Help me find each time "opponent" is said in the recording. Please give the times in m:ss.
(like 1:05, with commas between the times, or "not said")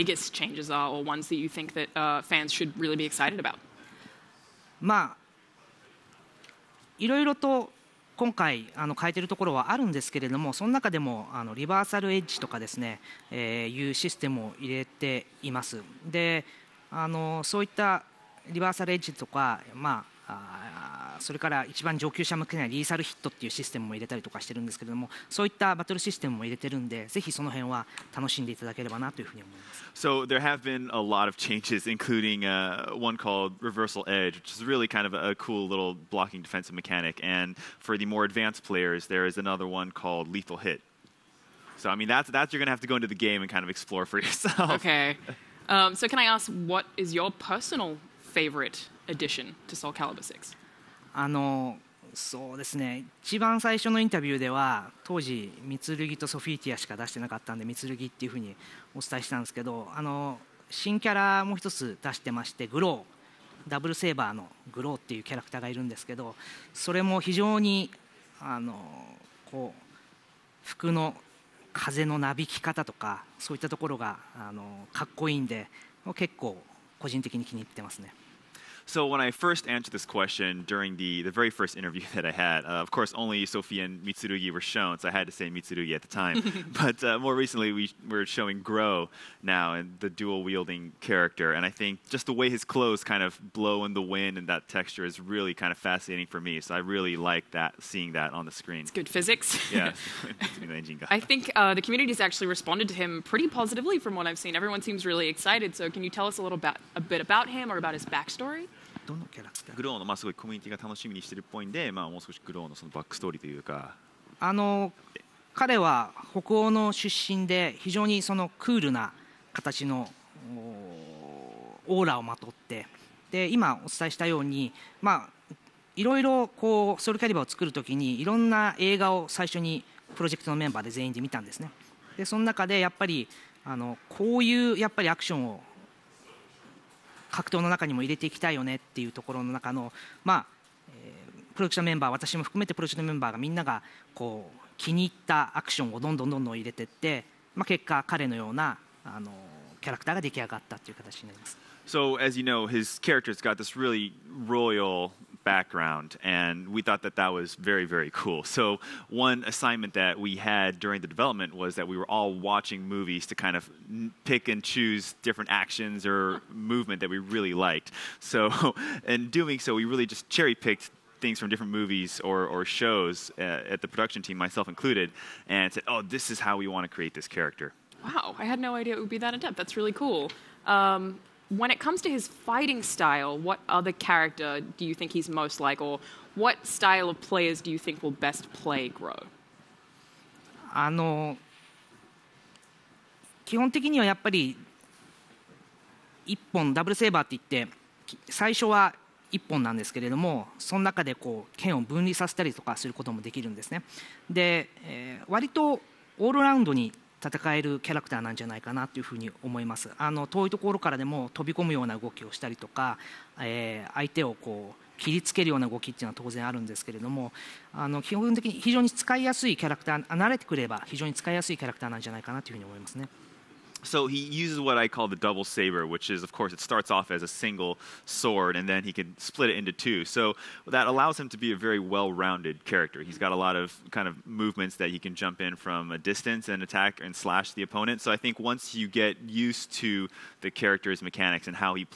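3:57.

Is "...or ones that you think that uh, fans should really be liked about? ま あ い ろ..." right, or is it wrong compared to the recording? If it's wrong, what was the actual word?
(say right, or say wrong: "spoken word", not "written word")
wrong: "excited", not "liked".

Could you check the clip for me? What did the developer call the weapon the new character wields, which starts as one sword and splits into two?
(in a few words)
double saber.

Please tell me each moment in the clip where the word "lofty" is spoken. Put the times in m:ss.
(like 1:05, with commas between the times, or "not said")
not said.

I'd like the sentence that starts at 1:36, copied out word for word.
So I really like that seeing that on the screen.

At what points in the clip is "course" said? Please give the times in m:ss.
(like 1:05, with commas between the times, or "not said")
1:22, 3:46.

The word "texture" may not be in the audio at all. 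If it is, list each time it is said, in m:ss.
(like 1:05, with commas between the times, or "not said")
1:34.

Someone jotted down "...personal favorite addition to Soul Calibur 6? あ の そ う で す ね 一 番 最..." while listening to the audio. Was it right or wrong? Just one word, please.
right.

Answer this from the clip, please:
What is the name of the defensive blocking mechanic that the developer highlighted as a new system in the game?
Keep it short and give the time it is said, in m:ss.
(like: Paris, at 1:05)
Reversal Edge, at 0:33.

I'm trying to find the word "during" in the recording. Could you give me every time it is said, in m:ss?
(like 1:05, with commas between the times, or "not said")
1:20, 2:40.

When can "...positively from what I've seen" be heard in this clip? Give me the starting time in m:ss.
1:43.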